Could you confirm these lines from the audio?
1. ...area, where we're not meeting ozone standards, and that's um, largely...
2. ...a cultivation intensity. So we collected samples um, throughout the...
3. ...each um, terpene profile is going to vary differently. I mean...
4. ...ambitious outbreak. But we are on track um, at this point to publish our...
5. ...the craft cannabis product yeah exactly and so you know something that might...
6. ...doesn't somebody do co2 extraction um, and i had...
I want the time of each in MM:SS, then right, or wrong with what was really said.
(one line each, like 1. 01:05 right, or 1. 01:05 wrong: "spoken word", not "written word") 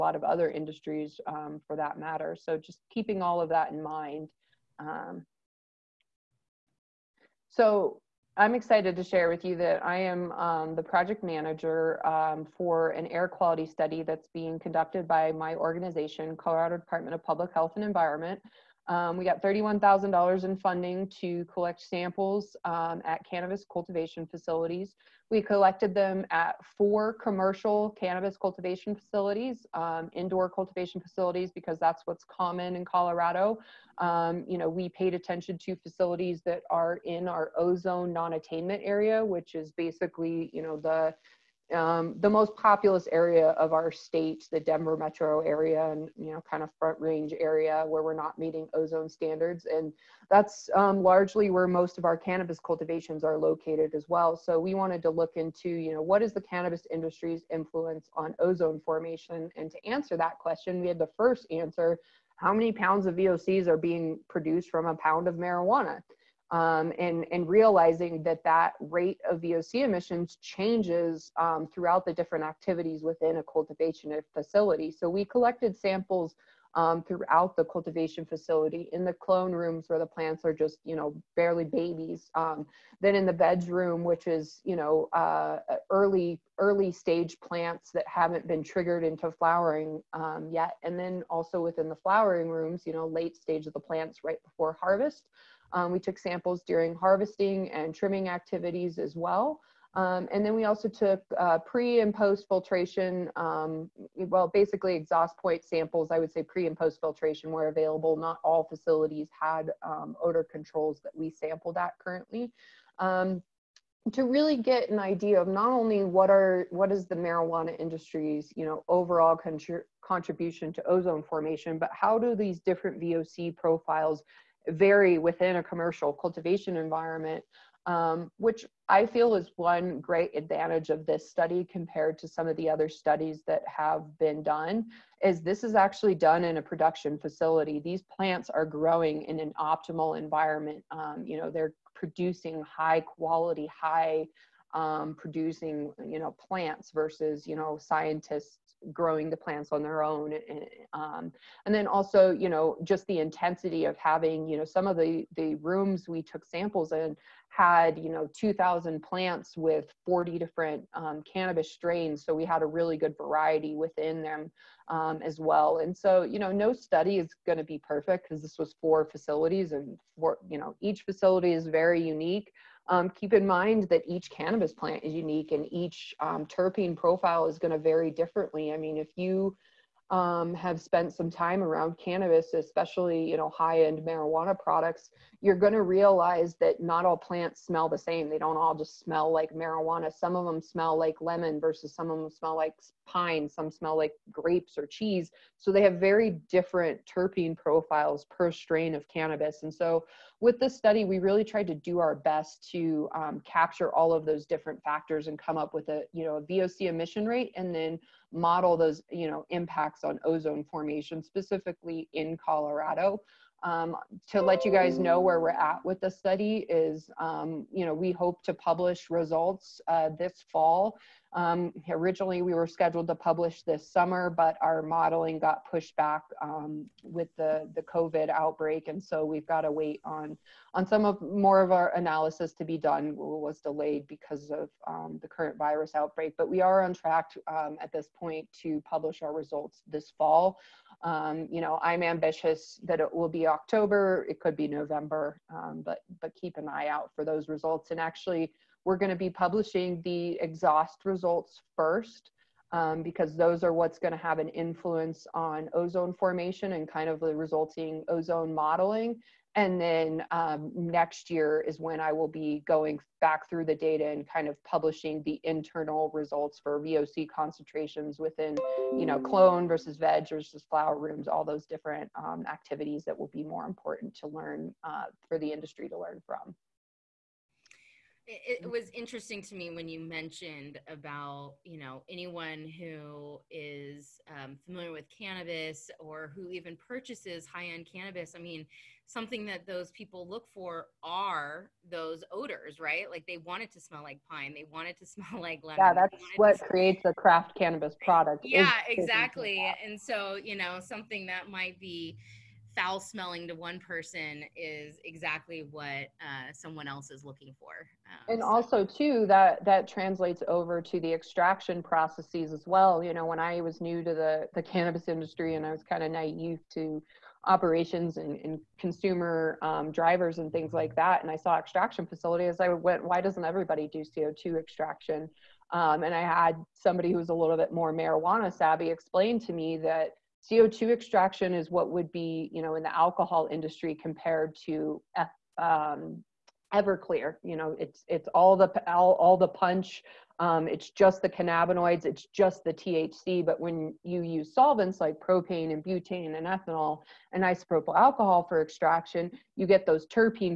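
1. 00:47 right
2. 01:13 wrong: "facility", not "intensity"
3. 02:55 right
4. 03:55 wrong: "virus", not "ambitious"
5. 04:57 right
6. 05:23 wrong: "everybody", not "somebody".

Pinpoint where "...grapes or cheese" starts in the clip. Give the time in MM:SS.
03:14.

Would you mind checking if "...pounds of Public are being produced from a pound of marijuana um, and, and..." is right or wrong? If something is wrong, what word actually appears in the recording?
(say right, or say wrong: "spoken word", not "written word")
wrong: "VOCs", not "Public".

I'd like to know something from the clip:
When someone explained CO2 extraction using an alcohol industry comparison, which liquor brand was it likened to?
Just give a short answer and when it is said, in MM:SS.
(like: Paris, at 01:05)
Everclear, at 05:36.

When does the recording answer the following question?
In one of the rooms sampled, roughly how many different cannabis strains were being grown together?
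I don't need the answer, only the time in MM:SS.
02:40.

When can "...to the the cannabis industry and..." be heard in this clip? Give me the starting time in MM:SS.
05:14.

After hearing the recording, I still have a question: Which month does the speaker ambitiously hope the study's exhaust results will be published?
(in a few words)
October.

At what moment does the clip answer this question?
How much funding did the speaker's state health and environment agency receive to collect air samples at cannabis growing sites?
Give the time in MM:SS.
00:19.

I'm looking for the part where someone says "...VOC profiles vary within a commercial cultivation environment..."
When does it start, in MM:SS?
02:03.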